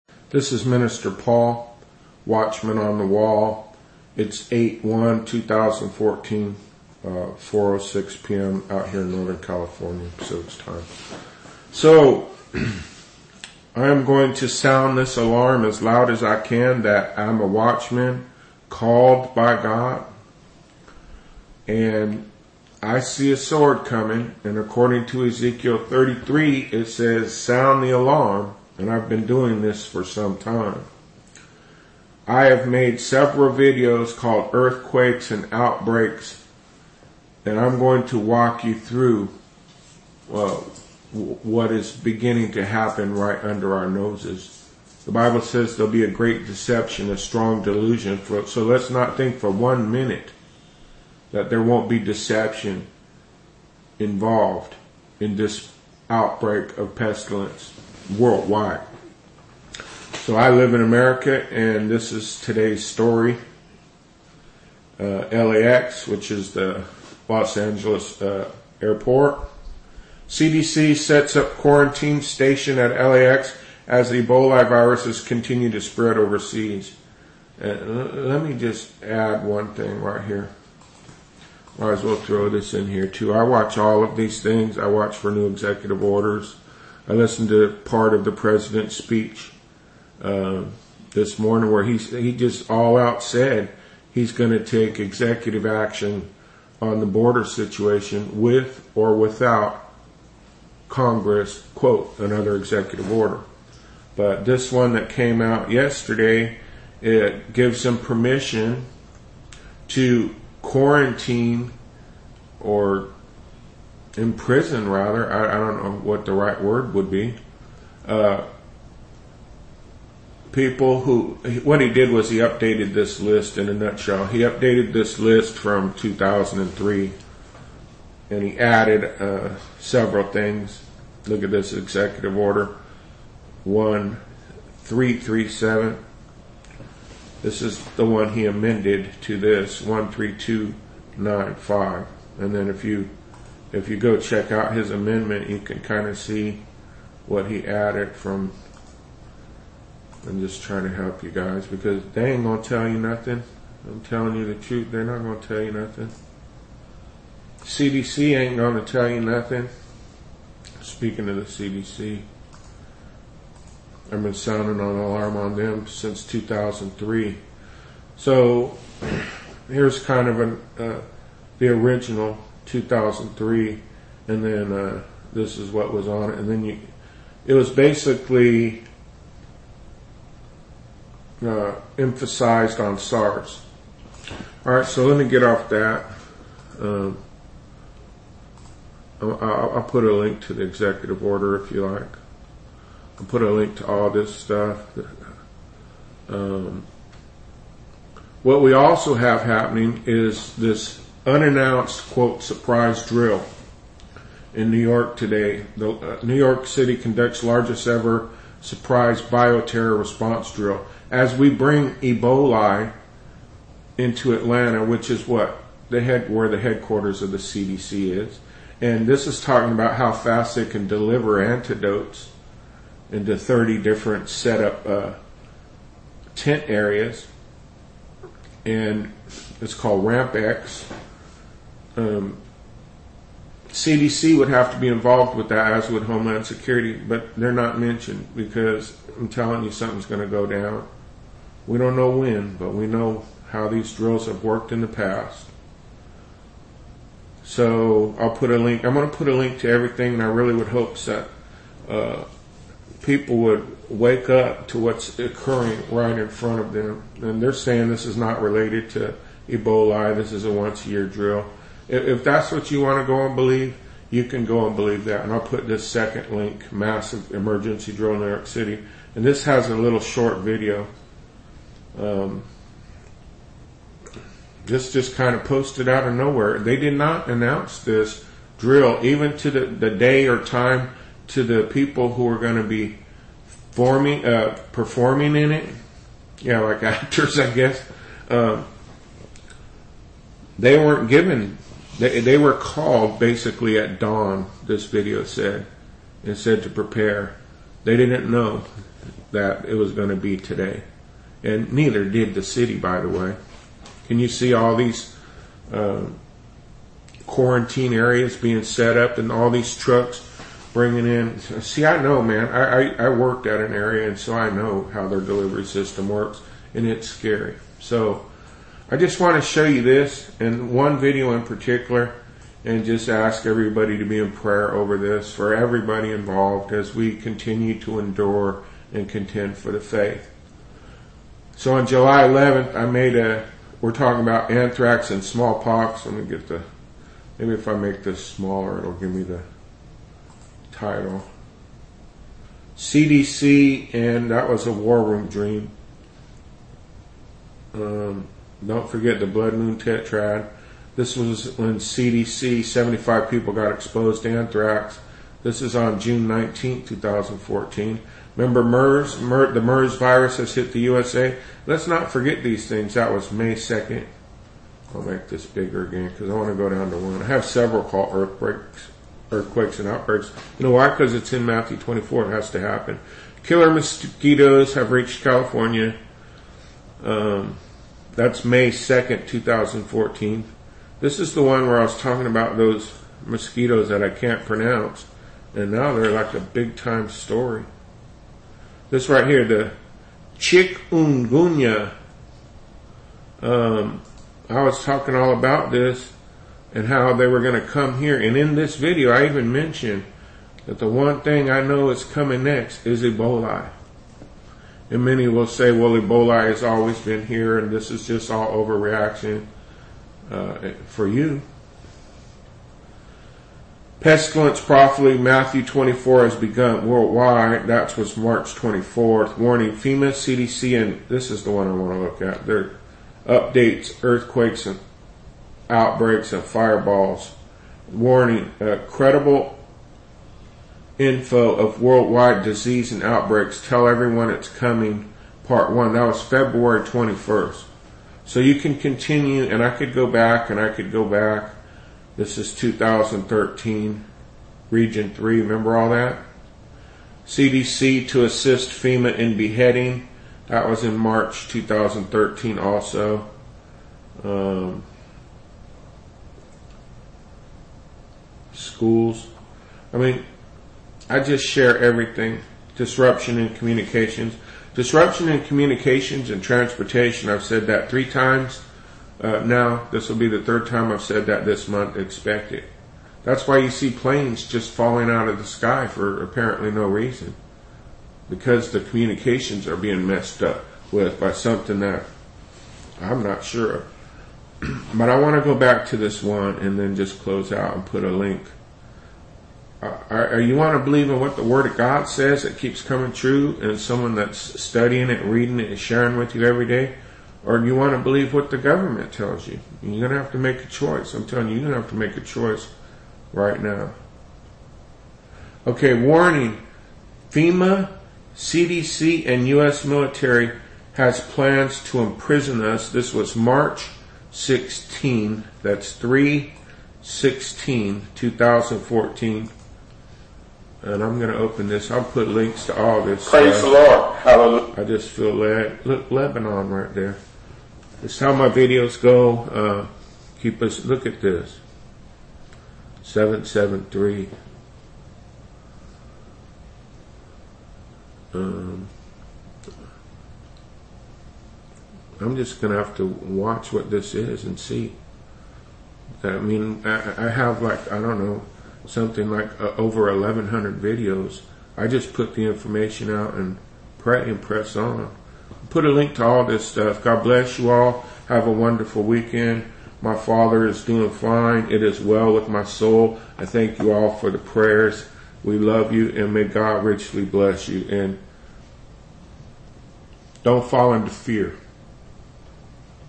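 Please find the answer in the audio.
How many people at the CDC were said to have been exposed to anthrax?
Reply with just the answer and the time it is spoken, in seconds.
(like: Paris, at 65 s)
75, at 352 s.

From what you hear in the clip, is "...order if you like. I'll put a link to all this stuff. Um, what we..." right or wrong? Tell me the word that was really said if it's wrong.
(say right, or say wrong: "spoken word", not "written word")
right.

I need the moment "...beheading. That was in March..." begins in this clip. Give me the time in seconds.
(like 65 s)
449 s.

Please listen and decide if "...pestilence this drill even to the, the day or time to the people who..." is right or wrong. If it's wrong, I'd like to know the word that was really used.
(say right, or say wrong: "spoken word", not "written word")
wrong: "announce", not "pestilence".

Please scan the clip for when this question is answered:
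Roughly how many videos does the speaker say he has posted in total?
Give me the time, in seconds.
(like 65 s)
549 s.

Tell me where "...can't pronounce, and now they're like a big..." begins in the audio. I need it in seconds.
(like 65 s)
384 s.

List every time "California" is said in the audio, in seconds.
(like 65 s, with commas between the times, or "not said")
9 s, 375 s.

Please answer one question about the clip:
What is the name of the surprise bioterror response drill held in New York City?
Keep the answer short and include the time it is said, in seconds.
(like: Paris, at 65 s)
Ramp X, at 230 s.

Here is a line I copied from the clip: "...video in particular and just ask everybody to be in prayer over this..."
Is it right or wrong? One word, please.
right.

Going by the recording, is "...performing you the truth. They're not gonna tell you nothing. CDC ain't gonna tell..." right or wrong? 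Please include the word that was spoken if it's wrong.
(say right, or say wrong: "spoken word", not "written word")
wrong: "telling", not "performing".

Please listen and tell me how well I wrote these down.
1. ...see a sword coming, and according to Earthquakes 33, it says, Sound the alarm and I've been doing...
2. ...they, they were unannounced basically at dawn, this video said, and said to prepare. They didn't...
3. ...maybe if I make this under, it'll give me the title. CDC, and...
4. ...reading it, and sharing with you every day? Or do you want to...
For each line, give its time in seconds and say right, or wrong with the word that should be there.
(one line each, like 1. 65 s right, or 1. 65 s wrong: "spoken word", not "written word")
1. 23 s wrong: "Ezekiel", not "Earthquakes"
2. 292 s wrong: "called", not "unannounced"
3. 337 s wrong: "smaller", not "under"
4. 495 s right.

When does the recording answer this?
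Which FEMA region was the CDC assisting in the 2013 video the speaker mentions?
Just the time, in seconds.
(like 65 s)
444 s.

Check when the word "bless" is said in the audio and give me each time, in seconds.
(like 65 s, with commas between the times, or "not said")
557 s, 567 s.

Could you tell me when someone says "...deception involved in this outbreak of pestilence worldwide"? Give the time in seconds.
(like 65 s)
51 s.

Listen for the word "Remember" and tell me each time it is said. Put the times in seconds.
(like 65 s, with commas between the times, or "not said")
358 s, 445 s.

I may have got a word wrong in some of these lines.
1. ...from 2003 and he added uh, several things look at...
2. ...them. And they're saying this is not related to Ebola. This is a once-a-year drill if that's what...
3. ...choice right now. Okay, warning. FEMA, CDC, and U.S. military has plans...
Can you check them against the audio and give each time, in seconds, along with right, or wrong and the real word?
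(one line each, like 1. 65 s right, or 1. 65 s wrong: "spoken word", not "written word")
1. 125 s right
2. 256 s right
3. 502 s right.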